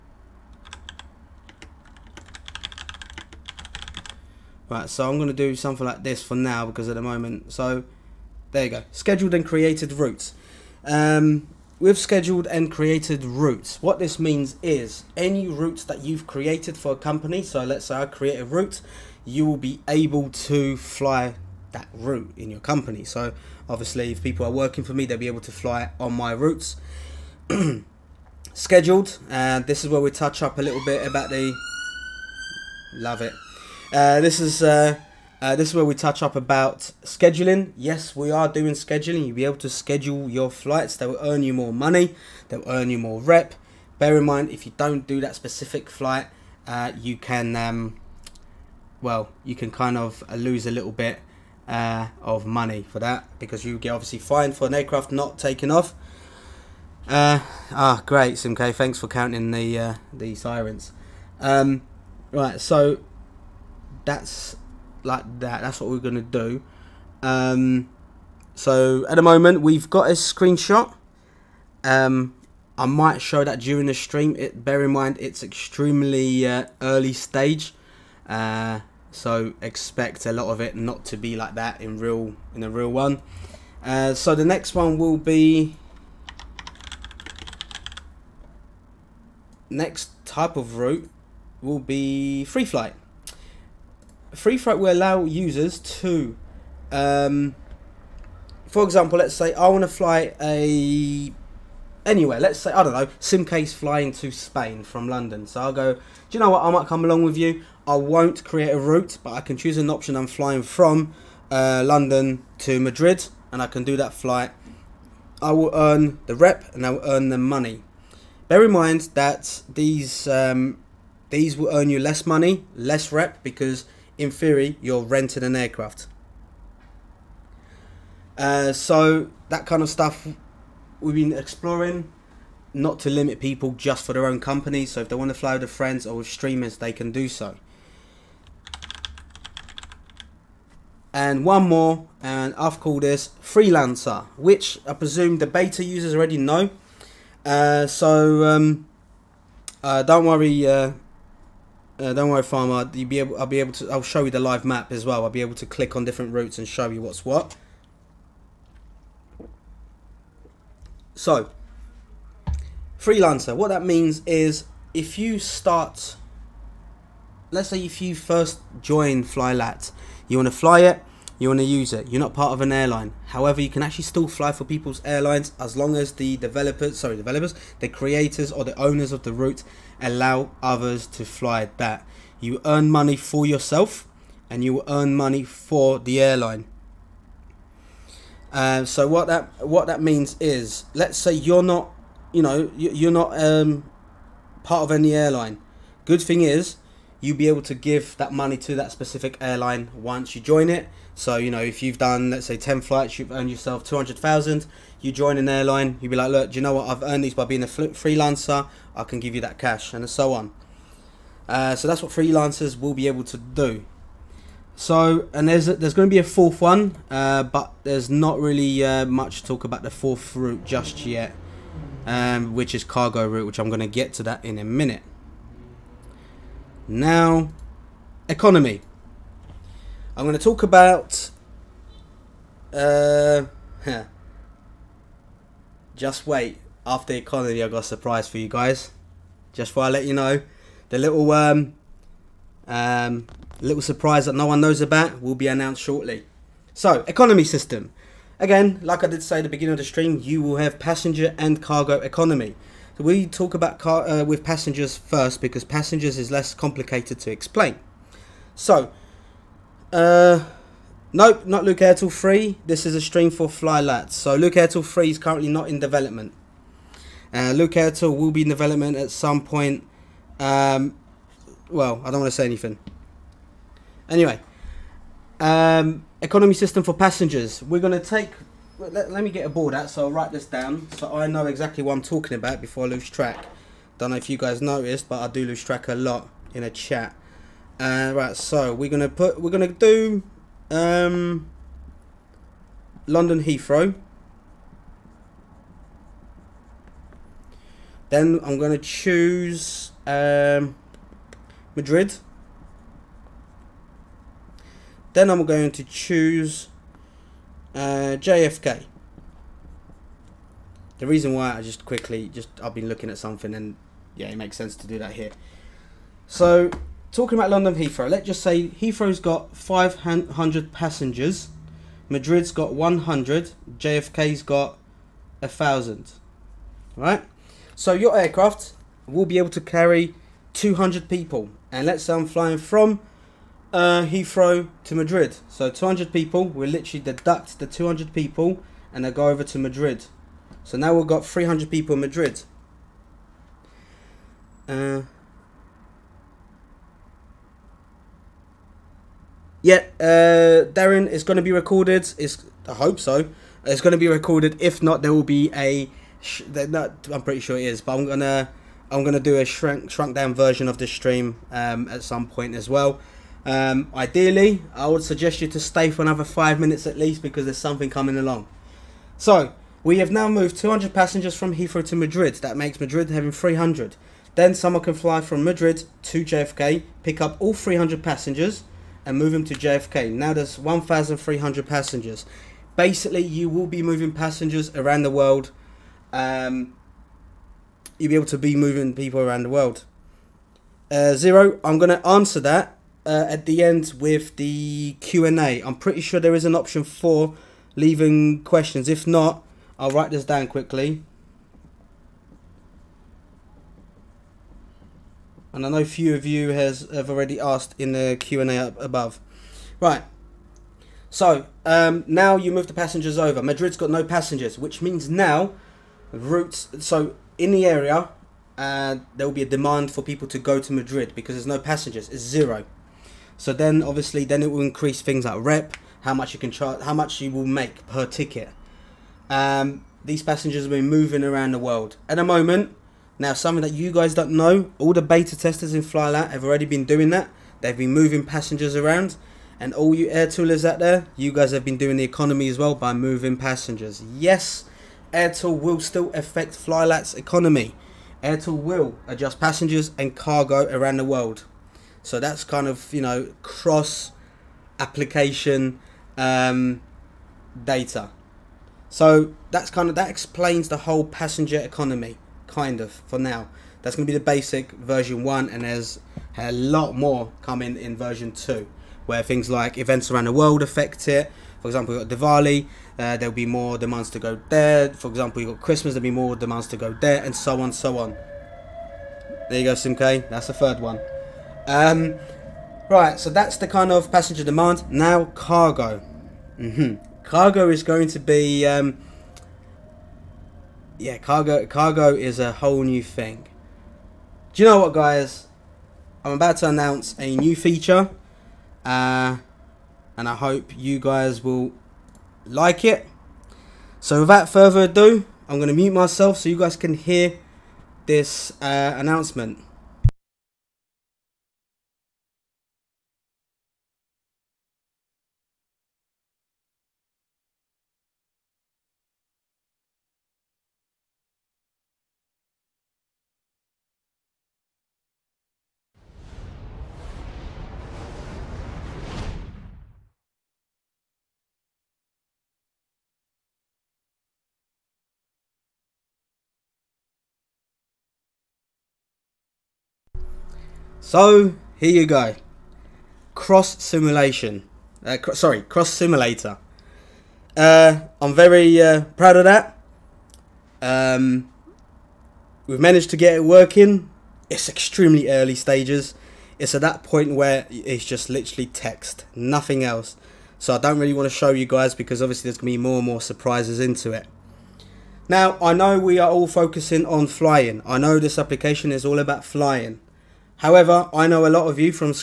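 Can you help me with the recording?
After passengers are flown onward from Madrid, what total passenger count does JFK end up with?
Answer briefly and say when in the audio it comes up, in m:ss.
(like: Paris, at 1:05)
1,300, at 6:20.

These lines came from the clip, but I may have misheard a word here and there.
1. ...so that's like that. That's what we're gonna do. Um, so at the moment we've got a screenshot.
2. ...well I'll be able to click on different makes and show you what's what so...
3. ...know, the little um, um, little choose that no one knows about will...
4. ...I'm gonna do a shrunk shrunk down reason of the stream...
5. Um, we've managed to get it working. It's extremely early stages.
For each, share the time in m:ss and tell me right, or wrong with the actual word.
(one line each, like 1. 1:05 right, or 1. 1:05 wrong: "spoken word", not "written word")
1. 1:02 right
2. 2:35 wrong: "routes", not "makes"
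3. 4:00 wrong: "surprise", not "choose"
4. 5:58 wrong: "version", not "reason"
5. 9:10 right.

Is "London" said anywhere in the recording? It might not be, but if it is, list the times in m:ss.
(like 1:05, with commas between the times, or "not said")
1:45, 1:51, 4:53, 5:17.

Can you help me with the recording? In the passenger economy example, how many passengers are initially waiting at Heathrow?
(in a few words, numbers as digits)
500.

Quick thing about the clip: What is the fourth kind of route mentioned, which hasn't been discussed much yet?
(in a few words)
Cargo route.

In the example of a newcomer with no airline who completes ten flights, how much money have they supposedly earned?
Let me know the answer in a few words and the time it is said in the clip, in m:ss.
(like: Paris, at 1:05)
200,000, at 3:23.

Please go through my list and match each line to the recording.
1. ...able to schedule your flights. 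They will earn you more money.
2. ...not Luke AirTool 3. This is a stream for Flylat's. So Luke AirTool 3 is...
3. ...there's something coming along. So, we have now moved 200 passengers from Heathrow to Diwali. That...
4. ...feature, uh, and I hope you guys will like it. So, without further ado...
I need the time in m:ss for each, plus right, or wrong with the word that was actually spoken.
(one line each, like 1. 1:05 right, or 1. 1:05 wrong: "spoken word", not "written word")
1. 0:39 right
2. 4:21 right
3. 6:07 wrong: "Madrid", not "Diwali"
4. 8:17 right.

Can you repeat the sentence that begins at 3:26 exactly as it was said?
I've earned these by being a freelancer.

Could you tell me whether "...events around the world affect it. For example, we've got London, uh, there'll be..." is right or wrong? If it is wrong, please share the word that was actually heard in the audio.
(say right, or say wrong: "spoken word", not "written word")
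wrong: "Diwali", not "London".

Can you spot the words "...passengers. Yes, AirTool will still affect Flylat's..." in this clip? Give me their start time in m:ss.
7:23.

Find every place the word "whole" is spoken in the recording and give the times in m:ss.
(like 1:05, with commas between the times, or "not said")
7:40, 8:12.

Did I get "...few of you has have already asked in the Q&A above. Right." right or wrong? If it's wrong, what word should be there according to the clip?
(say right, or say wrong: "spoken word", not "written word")
right.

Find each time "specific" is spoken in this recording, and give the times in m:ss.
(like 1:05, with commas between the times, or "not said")
0:45, 3:18.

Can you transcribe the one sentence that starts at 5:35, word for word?
So 200 people, we literally deduct the 200 people and they go over to Madrid.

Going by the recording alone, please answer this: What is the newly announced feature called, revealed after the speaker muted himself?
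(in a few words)
Cross simulator.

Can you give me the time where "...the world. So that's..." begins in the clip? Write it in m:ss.
7:30.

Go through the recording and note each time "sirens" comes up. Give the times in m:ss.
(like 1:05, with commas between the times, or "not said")
1:00.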